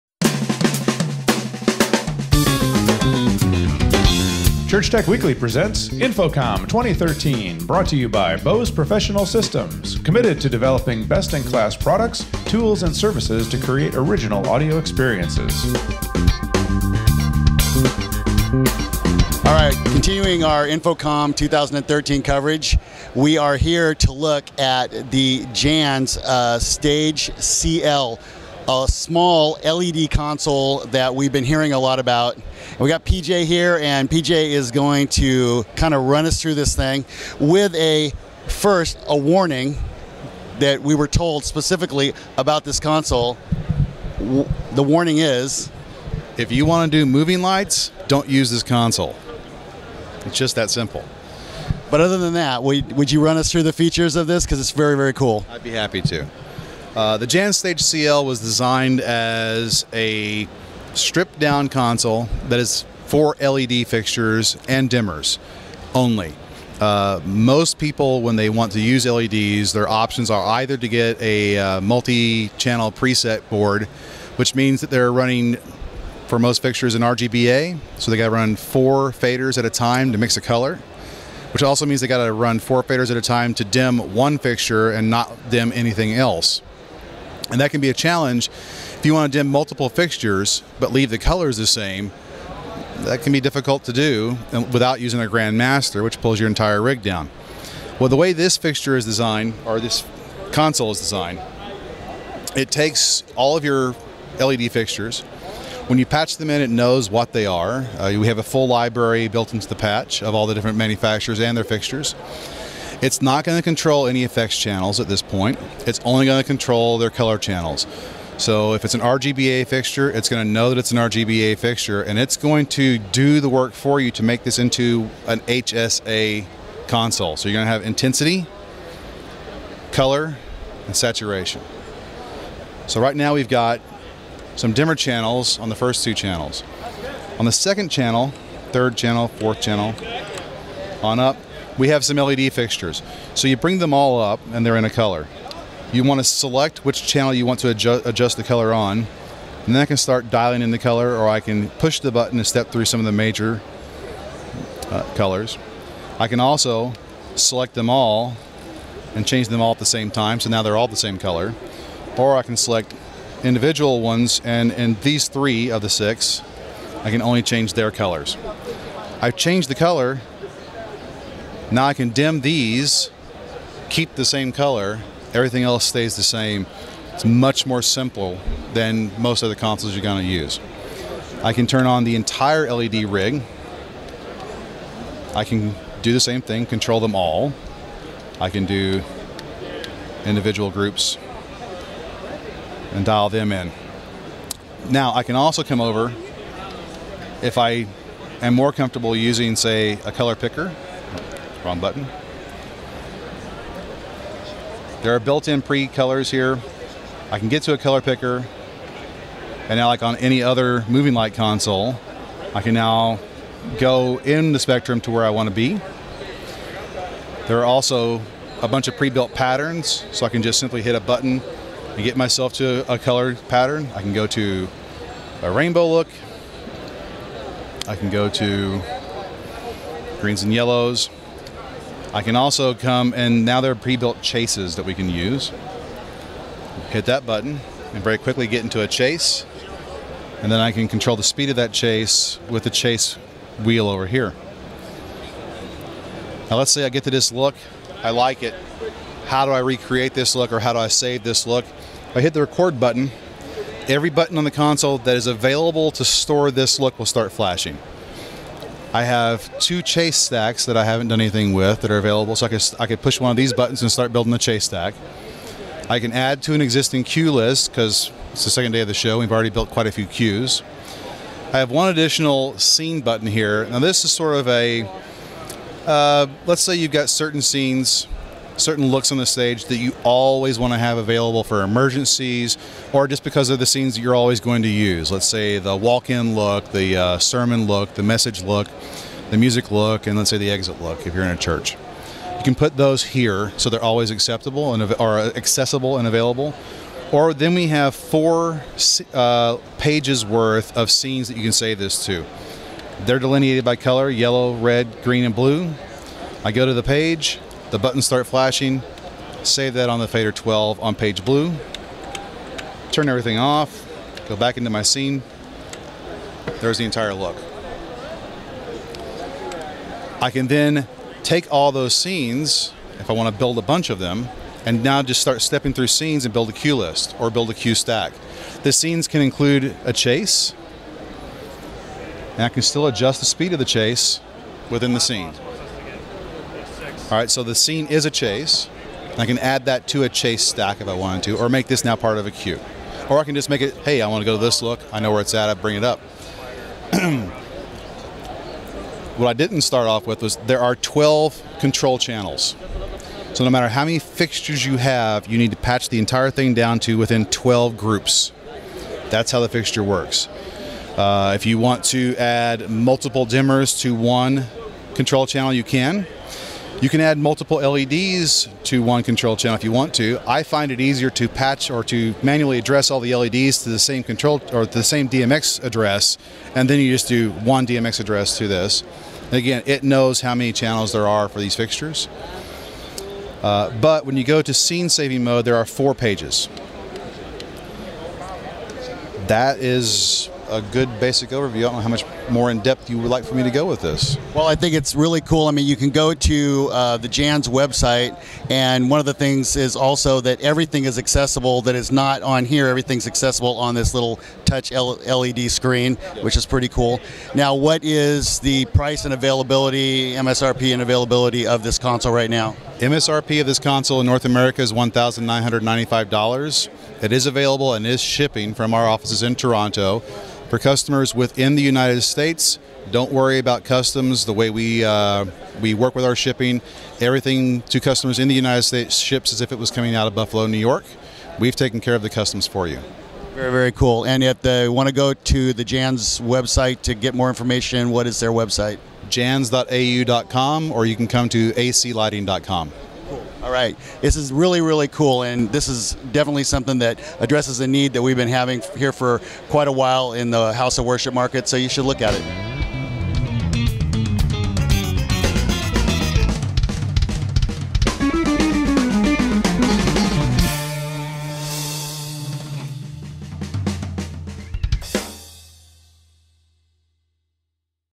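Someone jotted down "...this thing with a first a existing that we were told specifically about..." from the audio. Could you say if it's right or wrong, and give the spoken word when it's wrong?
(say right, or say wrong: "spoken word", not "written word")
wrong: "warning", not "existing".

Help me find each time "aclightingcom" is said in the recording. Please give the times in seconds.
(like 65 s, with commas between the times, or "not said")
441 s.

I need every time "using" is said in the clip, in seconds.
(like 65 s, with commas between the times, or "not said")
95 s, 199 s.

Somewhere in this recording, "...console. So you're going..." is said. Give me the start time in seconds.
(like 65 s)
126 s.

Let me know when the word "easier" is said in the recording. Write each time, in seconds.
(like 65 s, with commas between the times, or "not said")
370 s.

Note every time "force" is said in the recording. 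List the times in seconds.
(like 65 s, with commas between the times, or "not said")
not said.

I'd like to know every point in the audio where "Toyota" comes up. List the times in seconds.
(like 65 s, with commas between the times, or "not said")
not said.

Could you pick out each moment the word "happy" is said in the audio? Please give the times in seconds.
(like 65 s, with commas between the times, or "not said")
55 s.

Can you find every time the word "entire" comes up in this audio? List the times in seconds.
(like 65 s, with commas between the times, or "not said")
96 s, 182 s, 316 s, 355 s.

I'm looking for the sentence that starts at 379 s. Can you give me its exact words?
And again, it knows how many channels there are for these fixtures.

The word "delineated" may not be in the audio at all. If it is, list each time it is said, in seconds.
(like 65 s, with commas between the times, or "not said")
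303 s.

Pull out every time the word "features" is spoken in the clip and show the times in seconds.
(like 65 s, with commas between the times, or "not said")
53 s.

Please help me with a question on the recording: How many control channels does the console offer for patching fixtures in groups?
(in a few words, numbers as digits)
12.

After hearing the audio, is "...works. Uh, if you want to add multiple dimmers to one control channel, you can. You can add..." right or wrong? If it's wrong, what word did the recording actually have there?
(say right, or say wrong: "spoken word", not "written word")
right.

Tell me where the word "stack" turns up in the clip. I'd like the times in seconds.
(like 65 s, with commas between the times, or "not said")
260 s, 264 s, 327 s, 340 s.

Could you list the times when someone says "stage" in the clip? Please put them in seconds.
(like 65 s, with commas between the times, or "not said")
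26 s, 57 s, 279 s.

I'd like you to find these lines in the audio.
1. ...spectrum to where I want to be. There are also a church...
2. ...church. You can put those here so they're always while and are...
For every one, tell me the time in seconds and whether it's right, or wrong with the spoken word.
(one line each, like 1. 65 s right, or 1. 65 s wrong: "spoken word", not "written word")
1. 214 s wrong: "bunch", not "church"
2. 291 s wrong: "acceptable", not "while".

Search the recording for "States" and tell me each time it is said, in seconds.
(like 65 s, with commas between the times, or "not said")
422 s, 428 s.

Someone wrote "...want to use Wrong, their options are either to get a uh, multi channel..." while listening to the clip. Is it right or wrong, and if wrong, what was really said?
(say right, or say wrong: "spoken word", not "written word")
wrong: "LEDs", not "Wrong".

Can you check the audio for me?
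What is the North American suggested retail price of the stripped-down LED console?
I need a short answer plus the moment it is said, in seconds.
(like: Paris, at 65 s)
$1,995, at 414 s.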